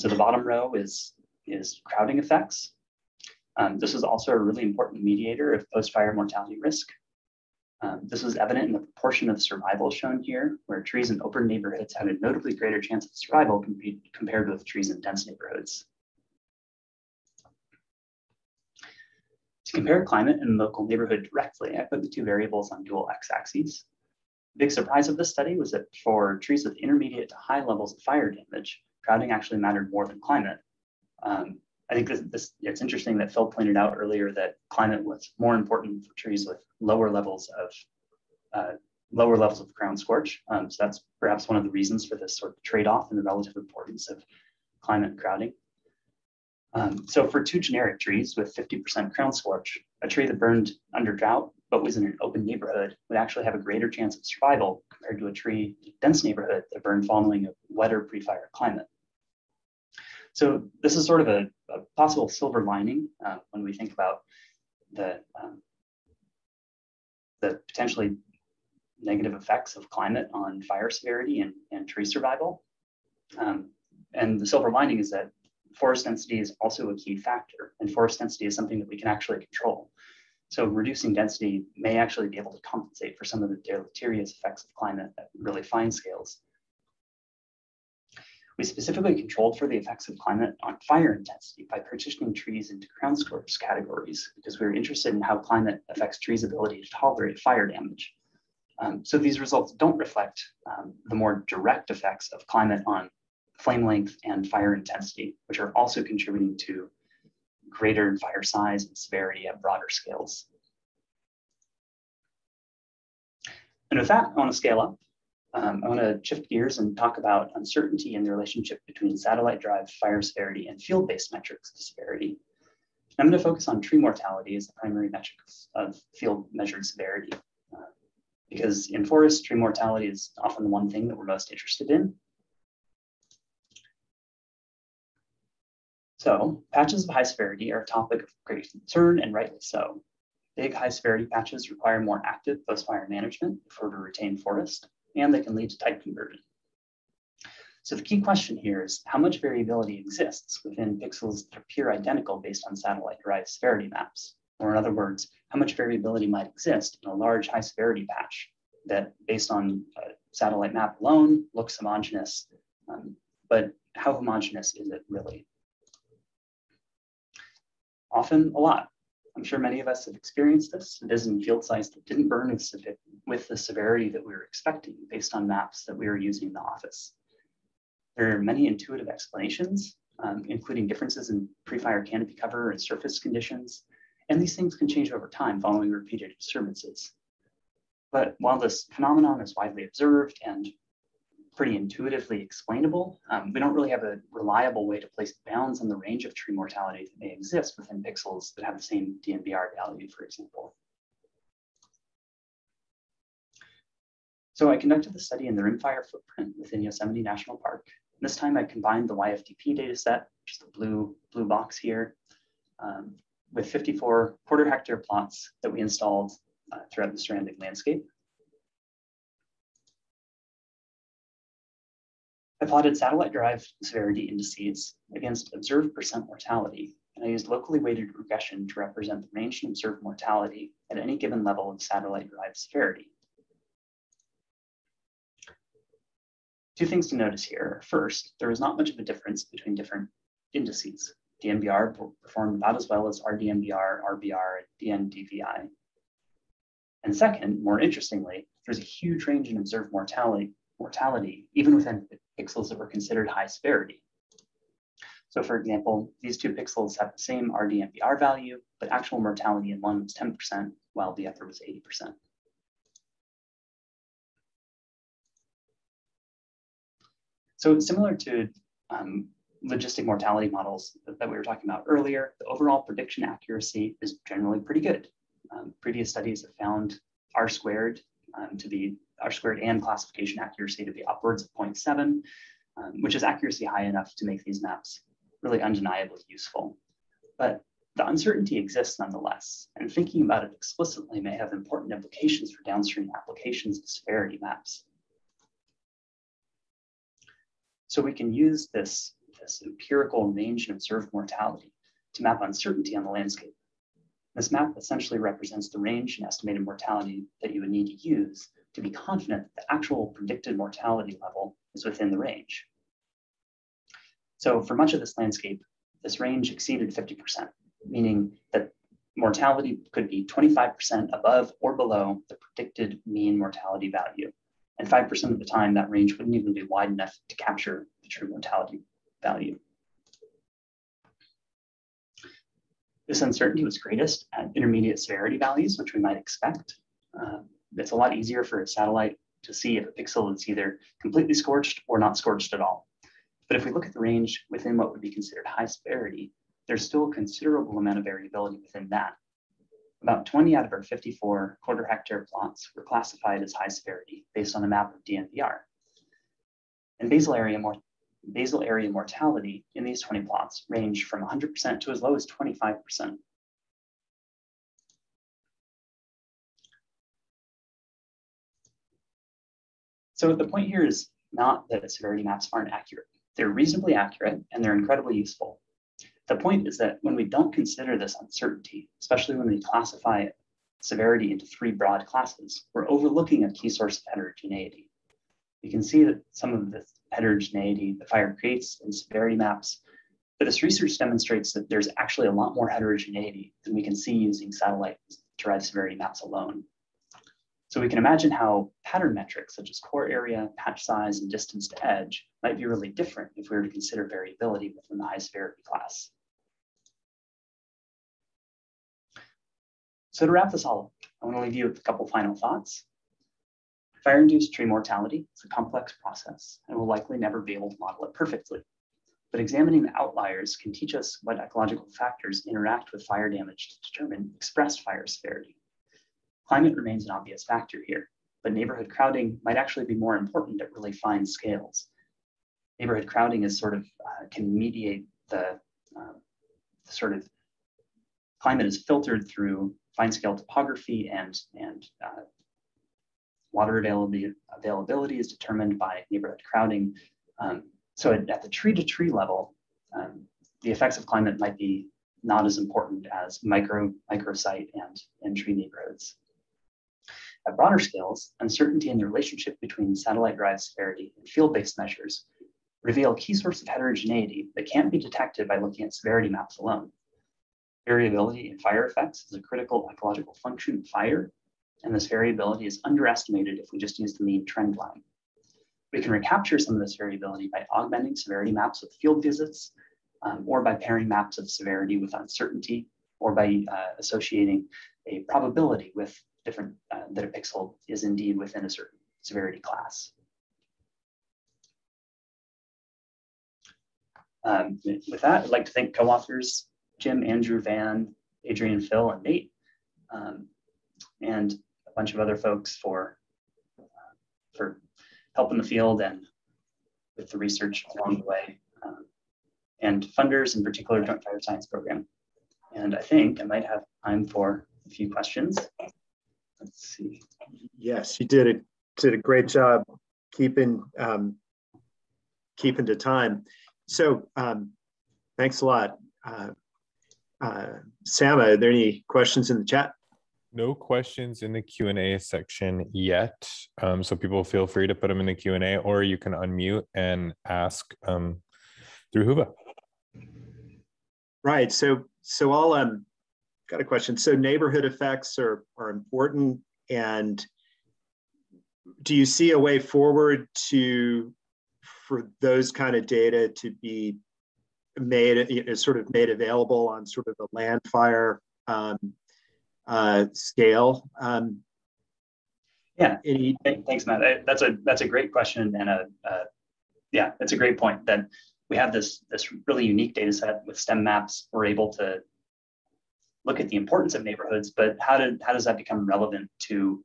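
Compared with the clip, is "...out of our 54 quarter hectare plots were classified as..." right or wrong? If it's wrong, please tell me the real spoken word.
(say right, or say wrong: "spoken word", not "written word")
right.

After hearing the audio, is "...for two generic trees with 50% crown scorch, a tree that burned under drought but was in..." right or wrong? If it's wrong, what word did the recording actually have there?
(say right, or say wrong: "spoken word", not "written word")
right.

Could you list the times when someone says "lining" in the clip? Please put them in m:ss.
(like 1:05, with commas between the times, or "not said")
1:02, 1:14.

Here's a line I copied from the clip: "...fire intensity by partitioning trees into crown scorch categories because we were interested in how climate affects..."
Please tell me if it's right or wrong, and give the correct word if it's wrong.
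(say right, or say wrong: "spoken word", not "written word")
right.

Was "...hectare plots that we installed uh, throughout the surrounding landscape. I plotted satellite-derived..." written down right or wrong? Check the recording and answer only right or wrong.
right.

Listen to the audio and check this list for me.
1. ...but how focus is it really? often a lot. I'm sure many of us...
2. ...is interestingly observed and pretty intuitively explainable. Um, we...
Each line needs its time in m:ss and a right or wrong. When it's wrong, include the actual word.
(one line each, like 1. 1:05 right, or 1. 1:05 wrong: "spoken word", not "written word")
1. 2:43 wrong: "homogeneous", not "focus"
2. 3:09 wrong: "widely", not "interestingly".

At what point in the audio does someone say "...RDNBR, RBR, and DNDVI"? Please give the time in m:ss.
4:03.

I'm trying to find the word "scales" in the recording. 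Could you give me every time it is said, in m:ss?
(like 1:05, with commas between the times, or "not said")
1:25, 1:49, 1:54, 7:11, 7:20, 7:37, 9:20.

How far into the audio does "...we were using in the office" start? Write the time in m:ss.
2:55.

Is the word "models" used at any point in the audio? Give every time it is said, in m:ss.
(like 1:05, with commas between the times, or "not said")
4:30, 6:57.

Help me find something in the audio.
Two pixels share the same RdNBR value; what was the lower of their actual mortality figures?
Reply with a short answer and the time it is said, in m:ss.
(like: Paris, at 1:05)
10%, at 4:20.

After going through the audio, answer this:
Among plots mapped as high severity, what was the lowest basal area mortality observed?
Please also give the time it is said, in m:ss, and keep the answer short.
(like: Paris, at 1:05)
25%, at 6:01.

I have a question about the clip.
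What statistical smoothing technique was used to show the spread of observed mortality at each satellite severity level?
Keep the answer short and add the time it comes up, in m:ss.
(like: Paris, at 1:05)
Locally weighted regression, at 3:47.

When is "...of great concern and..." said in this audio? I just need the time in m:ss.
2:18.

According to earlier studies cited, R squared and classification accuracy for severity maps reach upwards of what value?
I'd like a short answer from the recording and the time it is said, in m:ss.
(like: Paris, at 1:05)
0.7, at 4:41.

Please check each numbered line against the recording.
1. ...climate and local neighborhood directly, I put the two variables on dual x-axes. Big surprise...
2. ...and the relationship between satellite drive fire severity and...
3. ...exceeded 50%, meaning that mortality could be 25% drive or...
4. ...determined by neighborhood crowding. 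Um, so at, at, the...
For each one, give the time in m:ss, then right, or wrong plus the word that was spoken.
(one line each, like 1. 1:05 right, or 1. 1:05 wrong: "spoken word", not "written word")
1. 0:20 right
2. 1:58 right
3. 5:16 wrong: "above", not "drive"
4. 7:25 right.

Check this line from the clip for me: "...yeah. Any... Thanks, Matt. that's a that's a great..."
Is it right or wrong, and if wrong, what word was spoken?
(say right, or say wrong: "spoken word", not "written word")
right.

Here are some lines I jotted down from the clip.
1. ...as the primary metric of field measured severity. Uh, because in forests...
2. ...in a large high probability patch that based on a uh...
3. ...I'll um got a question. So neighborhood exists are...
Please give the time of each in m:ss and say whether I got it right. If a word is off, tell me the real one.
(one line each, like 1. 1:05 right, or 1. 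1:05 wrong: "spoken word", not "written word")
1. 2:04 right
2. 2:37 wrong: "severity", not "probability"
3. 9:02 wrong: "effects", not "exists".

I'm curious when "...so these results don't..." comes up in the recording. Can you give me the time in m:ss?
1:39.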